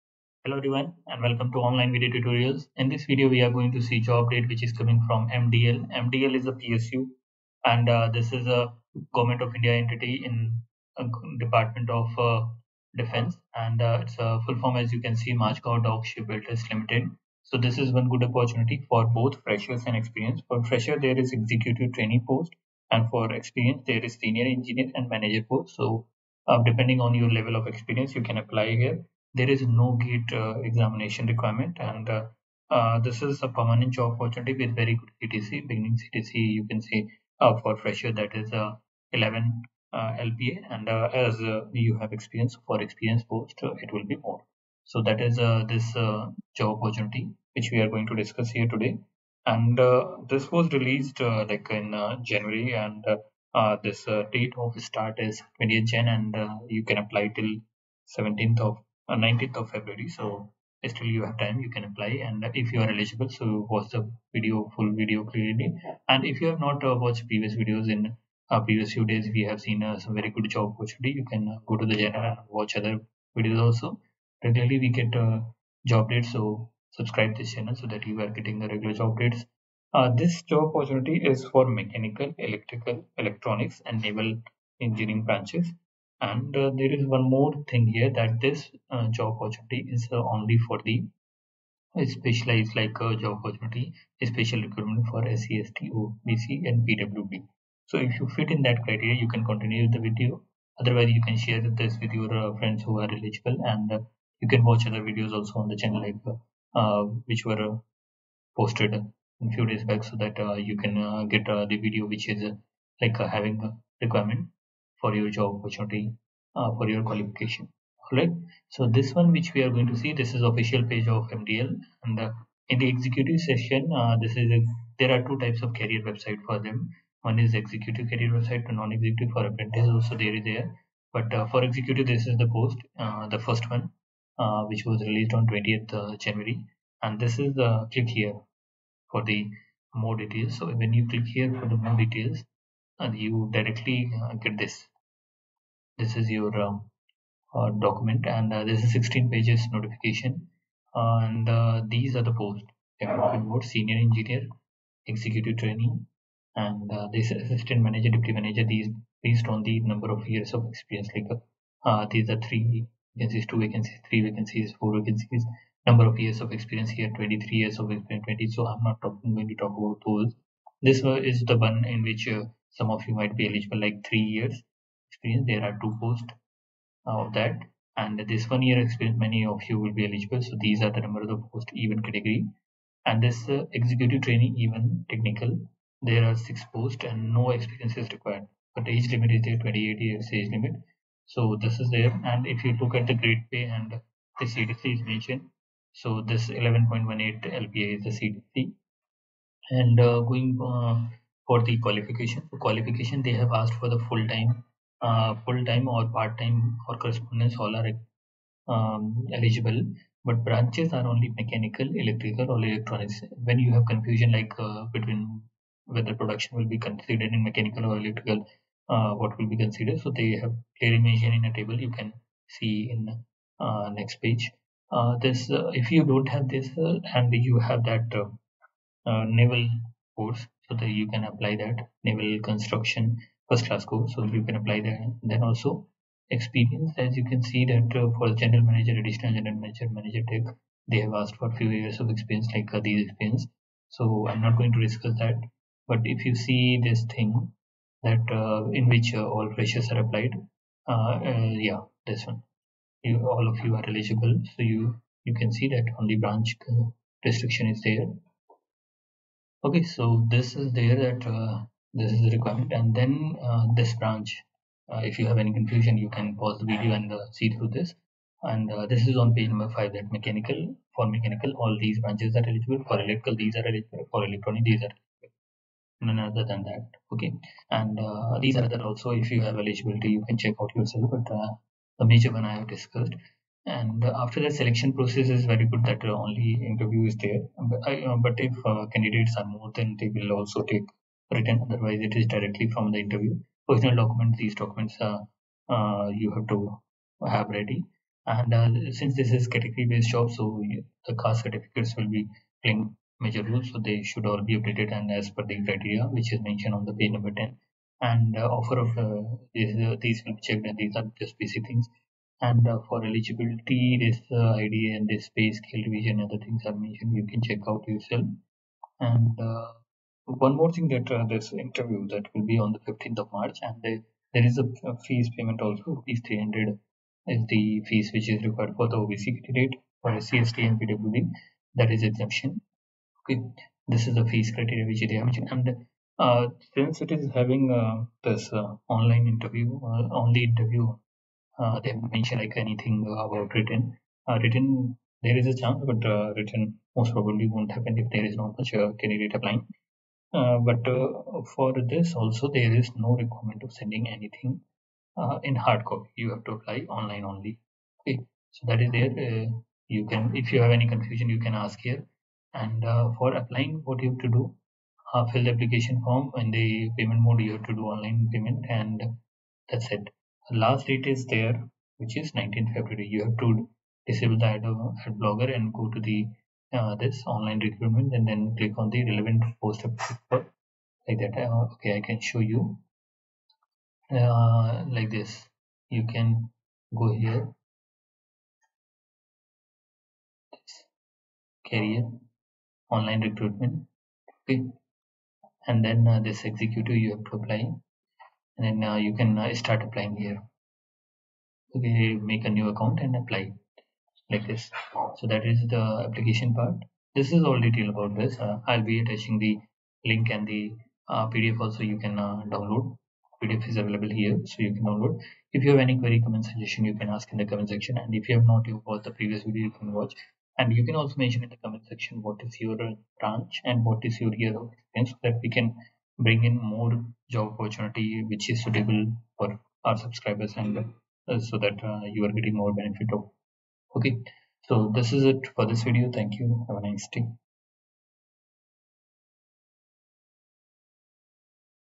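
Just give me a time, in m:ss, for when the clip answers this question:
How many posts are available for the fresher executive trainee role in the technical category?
3:06.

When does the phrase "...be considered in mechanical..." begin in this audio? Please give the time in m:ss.
3:36.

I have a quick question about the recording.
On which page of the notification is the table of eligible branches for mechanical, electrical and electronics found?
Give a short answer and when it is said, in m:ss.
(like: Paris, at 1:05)
Page 5, at 4:29.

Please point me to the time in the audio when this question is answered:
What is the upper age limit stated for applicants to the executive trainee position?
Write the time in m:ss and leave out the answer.
3:09.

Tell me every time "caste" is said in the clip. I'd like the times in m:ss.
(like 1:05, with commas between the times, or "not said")
5:01.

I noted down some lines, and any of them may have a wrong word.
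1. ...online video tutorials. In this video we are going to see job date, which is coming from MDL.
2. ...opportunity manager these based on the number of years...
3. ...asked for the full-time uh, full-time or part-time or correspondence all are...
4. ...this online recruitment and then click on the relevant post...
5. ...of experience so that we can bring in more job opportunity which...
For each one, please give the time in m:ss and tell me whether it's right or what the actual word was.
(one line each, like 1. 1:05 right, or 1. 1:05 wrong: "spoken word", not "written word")
1. 0:01 right
2. 2:38 wrong: "deputy", not "opportunity"
3. 3:23 right
4. 6:16 right
5. 7:04 right.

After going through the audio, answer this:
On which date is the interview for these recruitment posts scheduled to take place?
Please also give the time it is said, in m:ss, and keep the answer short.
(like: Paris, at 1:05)
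15 March, at 5:22.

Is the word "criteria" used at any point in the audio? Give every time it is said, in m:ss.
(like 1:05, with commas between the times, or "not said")
1:38, 5:05, 5:34.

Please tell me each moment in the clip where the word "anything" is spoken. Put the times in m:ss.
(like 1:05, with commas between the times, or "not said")
5:42, 5:54.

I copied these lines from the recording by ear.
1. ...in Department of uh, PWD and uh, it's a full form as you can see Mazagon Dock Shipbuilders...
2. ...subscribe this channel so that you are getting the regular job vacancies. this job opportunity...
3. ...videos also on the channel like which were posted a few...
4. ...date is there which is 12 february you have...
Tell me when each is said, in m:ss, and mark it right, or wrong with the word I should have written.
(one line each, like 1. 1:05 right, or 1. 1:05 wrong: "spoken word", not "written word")
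1. 0:10 wrong: "Defense", not "PWD"
2. 1:16 wrong: "dates", not "vacancies"
3. 1:45 right
4. 6:10 wrong: "19", not "12".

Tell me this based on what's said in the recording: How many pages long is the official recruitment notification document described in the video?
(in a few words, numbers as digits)
16.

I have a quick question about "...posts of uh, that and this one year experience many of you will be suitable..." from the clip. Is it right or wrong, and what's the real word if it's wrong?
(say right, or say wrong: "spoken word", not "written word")
wrong: "eligible", not "suitable".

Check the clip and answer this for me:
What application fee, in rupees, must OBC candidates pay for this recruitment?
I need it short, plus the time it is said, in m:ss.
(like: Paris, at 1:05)
300, at 5:26.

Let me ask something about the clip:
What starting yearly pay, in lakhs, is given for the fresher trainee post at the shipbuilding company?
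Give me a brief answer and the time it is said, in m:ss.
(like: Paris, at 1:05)
11.18 LPA, at 3:16.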